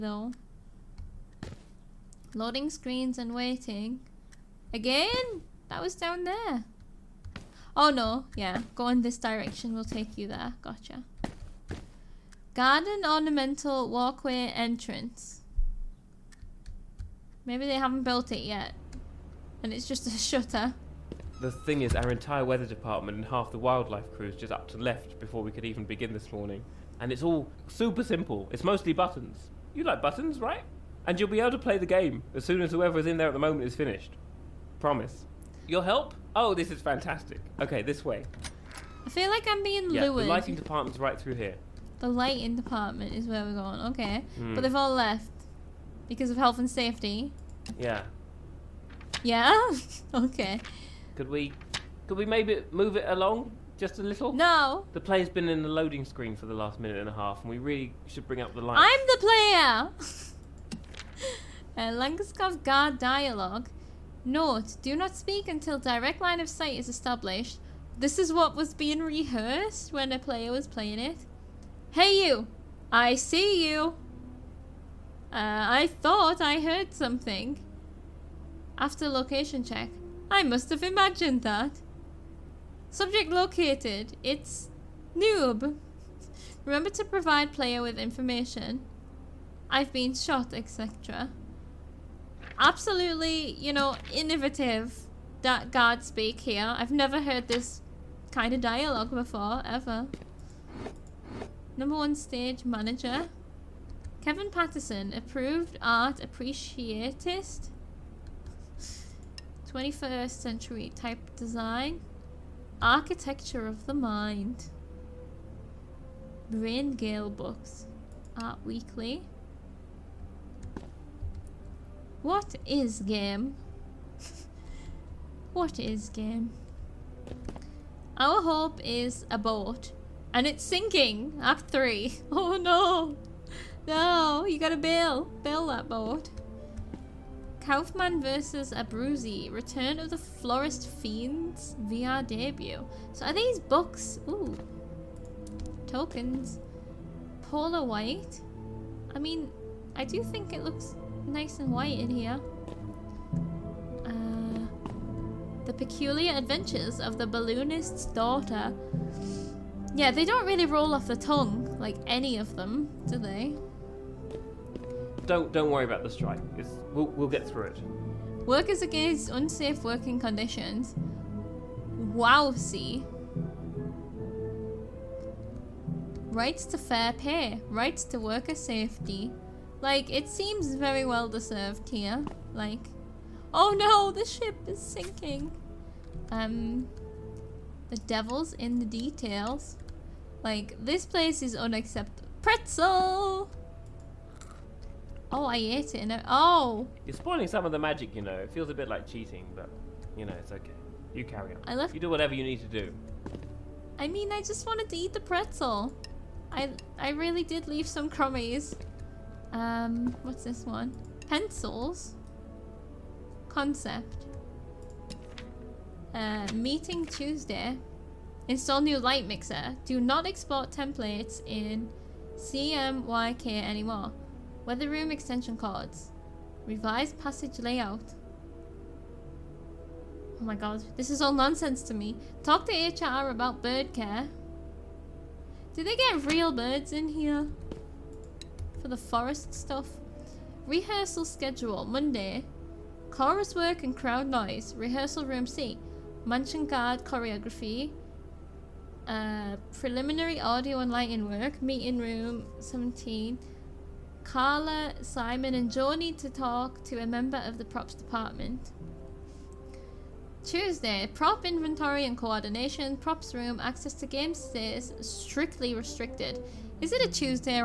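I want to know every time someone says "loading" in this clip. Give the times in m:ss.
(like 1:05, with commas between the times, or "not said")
0:02, 0:55.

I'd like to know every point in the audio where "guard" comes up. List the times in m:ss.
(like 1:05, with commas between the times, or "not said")
1:02, 1:35, 4:06.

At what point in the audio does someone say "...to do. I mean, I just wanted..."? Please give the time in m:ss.
3:22.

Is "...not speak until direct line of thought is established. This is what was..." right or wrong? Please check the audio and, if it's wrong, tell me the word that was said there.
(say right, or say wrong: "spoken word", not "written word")
wrong: "sight", not "thought".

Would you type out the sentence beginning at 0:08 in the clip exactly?
Go in this direction, we'll take you there.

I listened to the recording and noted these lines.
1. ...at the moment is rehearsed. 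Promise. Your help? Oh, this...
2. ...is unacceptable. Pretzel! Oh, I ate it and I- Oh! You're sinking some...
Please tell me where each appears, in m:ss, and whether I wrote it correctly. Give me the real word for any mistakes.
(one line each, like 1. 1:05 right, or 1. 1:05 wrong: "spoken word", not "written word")
1. 0:33 wrong: "finished", not "rehearsed"
2. 3:11 wrong: "spoiling", not "sinking".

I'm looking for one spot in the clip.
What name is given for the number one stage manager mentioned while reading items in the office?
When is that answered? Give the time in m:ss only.
1:44.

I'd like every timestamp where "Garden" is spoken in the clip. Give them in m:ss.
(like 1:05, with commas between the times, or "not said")
0:12.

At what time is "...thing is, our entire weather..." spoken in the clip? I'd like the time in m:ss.
0:21.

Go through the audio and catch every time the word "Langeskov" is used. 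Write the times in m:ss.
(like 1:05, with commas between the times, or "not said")
1:01.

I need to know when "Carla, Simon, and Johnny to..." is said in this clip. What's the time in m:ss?
4:14.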